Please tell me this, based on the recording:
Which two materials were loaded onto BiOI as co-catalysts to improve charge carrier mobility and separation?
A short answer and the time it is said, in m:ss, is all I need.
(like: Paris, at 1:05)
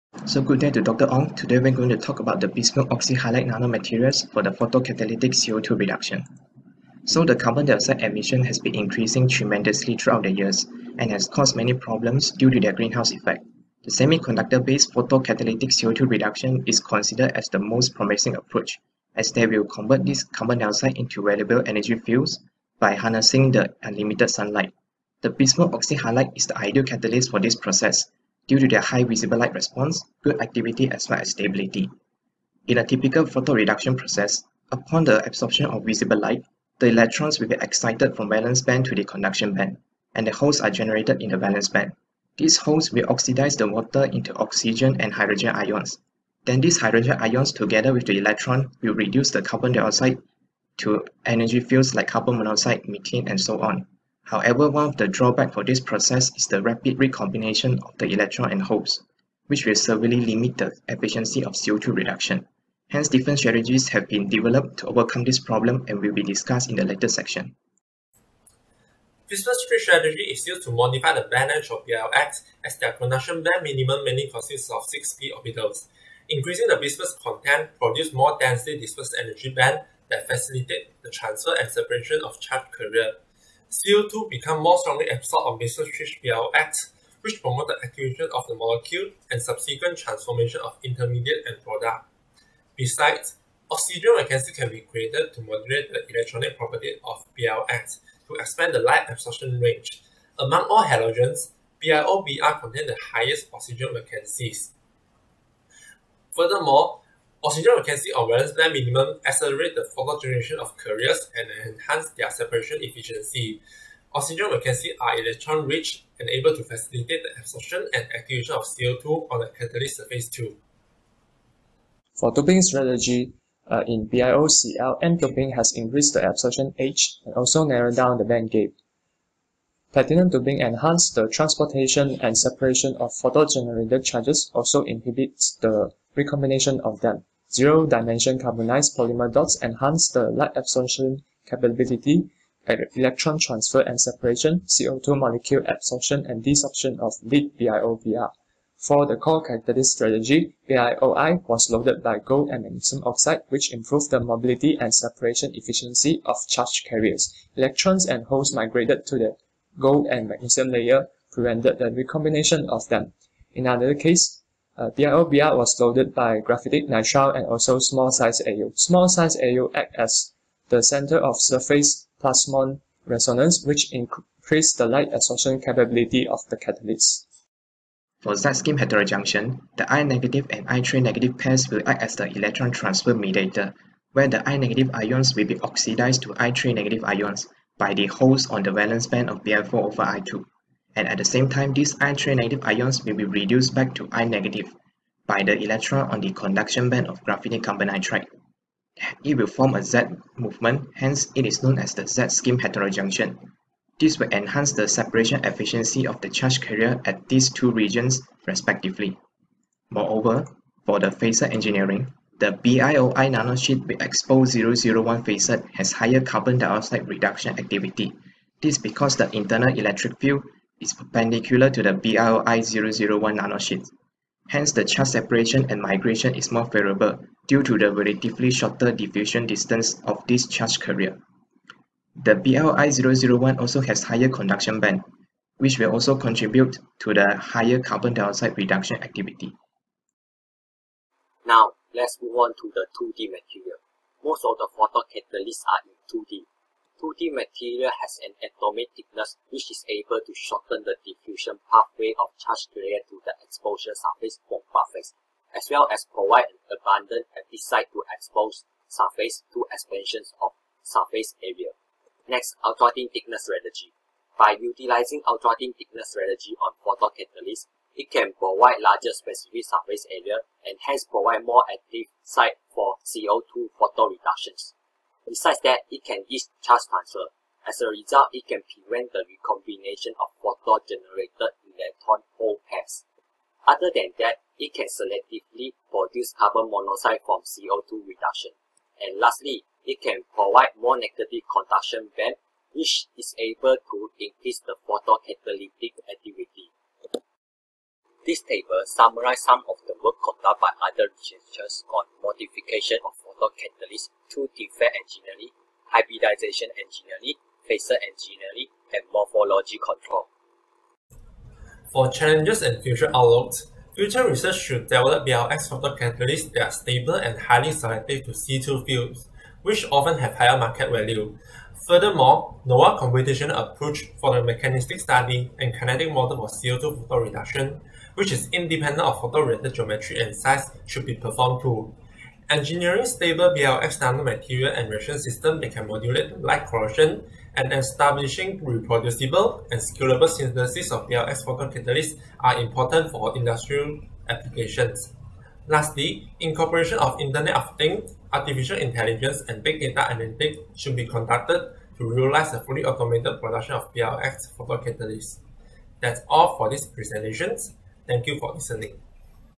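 Gold and magnesium oxide, at 2:32.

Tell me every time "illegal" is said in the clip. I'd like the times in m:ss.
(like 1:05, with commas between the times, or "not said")
not said.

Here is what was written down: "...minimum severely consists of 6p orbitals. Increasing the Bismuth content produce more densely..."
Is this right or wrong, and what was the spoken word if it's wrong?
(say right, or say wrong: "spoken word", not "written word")
wrong: "mainly", not "severely".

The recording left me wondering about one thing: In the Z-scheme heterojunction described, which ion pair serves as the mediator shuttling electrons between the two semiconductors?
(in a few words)
I- and I3-.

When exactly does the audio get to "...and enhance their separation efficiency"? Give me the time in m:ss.
1:51.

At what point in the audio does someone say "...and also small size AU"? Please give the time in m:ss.
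2:47.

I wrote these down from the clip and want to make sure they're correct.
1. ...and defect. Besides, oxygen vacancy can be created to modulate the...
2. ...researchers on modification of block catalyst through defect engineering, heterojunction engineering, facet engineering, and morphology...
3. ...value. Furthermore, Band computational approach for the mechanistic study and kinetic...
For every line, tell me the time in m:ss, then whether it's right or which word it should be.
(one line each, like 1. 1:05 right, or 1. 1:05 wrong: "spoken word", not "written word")
1. 1:31 wrong: "product", not "defect"
2. 5:01 wrong: "hybridization", not "heterojunction"
3. 5:20 wrong: "NOAA", not "Band".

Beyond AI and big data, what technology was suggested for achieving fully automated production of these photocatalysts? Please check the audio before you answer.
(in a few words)
Internet of Things.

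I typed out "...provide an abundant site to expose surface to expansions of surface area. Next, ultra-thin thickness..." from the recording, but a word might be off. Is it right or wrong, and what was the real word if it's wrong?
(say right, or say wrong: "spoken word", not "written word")
right.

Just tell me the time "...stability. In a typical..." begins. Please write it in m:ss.
0:31.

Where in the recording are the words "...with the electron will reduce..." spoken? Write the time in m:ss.
0:47.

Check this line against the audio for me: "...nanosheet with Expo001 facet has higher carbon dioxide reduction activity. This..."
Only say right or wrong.
right.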